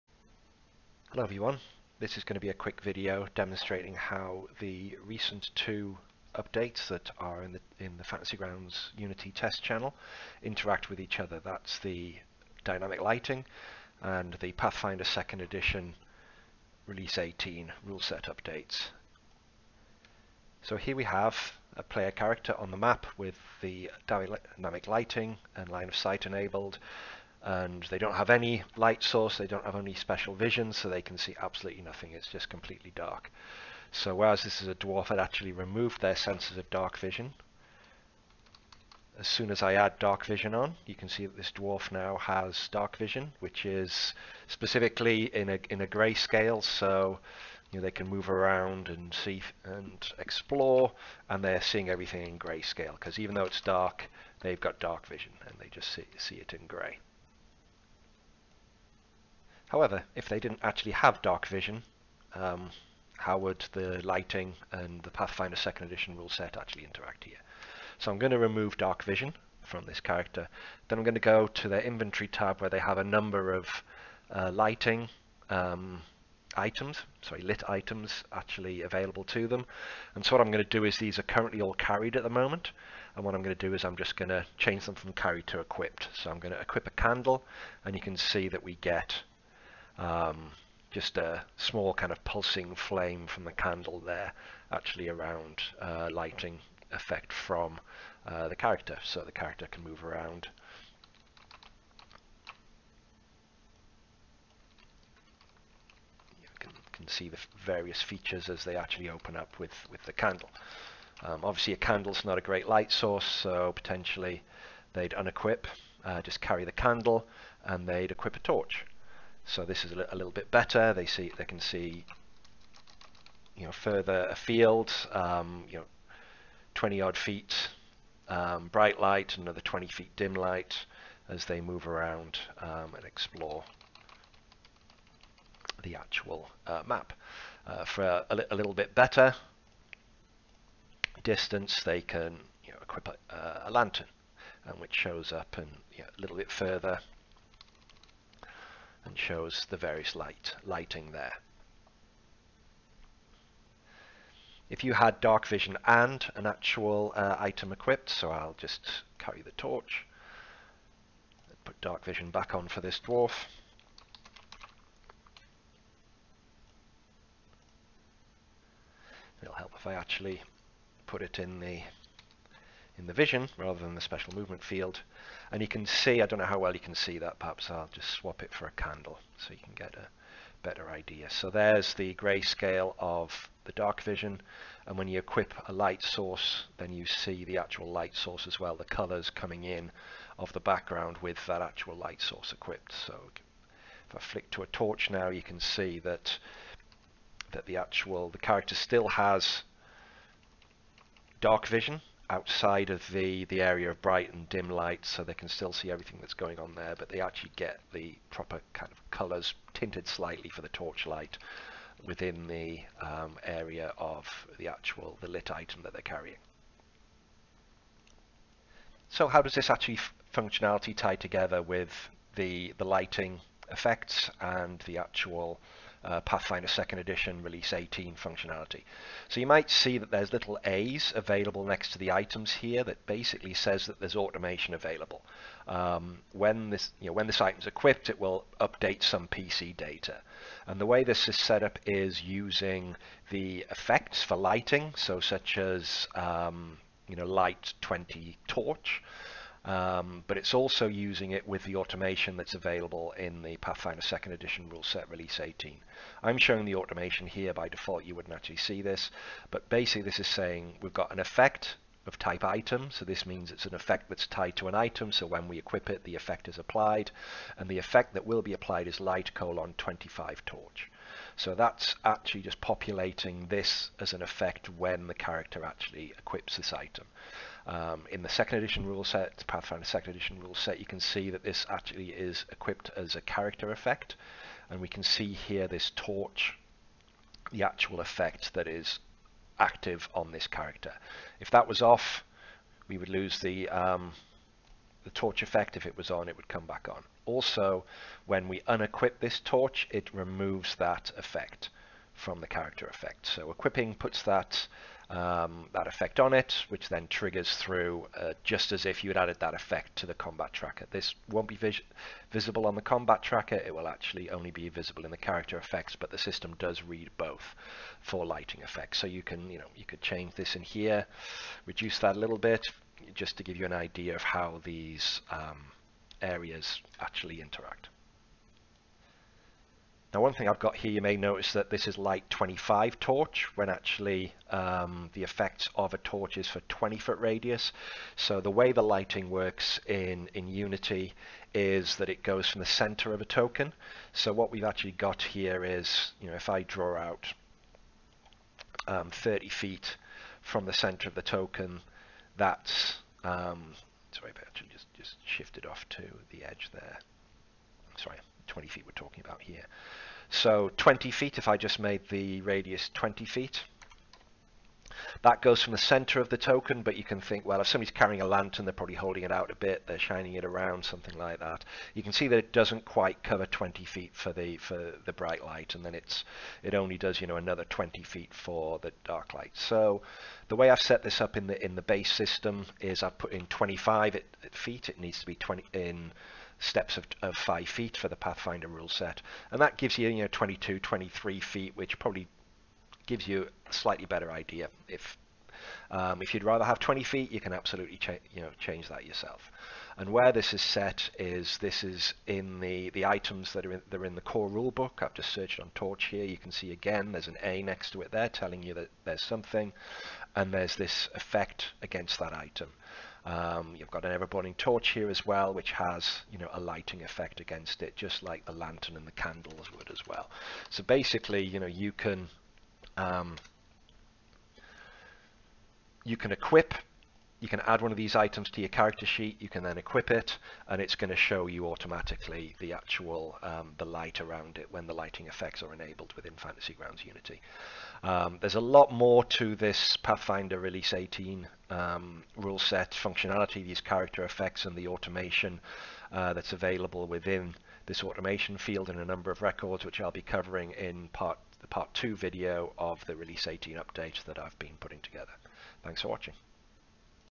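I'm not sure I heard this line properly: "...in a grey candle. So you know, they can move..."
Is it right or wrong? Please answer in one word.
wrong.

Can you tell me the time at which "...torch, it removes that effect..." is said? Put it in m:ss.
4:59.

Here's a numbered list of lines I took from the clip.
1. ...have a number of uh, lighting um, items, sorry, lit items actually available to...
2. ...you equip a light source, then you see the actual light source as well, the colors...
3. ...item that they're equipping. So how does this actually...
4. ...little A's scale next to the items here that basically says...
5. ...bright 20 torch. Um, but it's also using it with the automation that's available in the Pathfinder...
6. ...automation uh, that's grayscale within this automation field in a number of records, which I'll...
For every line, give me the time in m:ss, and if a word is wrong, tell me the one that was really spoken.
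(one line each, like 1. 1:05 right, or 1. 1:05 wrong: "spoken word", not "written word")
1. 1:12 right
2. 3:05 right
3. 3:35 wrong: "carrying", not "equipping"
4. 3:50 wrong: "available", not "scale"
5. 4:07 wrong: "light", not "bright"
6. 7:24 wrong: "available", not "grayscale".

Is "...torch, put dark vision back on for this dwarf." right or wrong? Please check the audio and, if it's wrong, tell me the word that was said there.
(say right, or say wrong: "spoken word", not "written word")
right.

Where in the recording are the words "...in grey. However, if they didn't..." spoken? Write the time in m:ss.
0:56.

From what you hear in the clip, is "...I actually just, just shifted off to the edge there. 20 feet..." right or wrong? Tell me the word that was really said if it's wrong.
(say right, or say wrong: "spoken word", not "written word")
right.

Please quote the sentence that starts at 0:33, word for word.
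So whereas this is a dwarf, it actually removed their senses of dark vision.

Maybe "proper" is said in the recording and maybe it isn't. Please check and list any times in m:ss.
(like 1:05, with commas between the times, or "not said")
3:28.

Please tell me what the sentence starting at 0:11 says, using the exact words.
That's the dynamic lighting and the Pathfinder 2nd edition release 18 rule set updates.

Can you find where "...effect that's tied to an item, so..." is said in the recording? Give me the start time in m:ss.
4:23.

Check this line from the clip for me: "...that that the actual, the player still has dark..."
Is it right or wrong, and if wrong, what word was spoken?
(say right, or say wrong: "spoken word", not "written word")
wrong: "character", not "player".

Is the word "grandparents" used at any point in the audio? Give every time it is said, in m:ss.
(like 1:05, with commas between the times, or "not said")
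not said.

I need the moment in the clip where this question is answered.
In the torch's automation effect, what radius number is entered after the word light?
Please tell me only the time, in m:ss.
4:28.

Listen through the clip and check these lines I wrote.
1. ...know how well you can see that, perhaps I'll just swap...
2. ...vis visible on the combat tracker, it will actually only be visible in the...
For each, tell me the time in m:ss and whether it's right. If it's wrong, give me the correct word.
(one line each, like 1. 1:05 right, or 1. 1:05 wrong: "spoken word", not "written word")
1. 2:56 right
2. 5:11 right.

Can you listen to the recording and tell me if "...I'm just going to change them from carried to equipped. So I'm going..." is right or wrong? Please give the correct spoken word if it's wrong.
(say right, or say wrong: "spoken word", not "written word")
right.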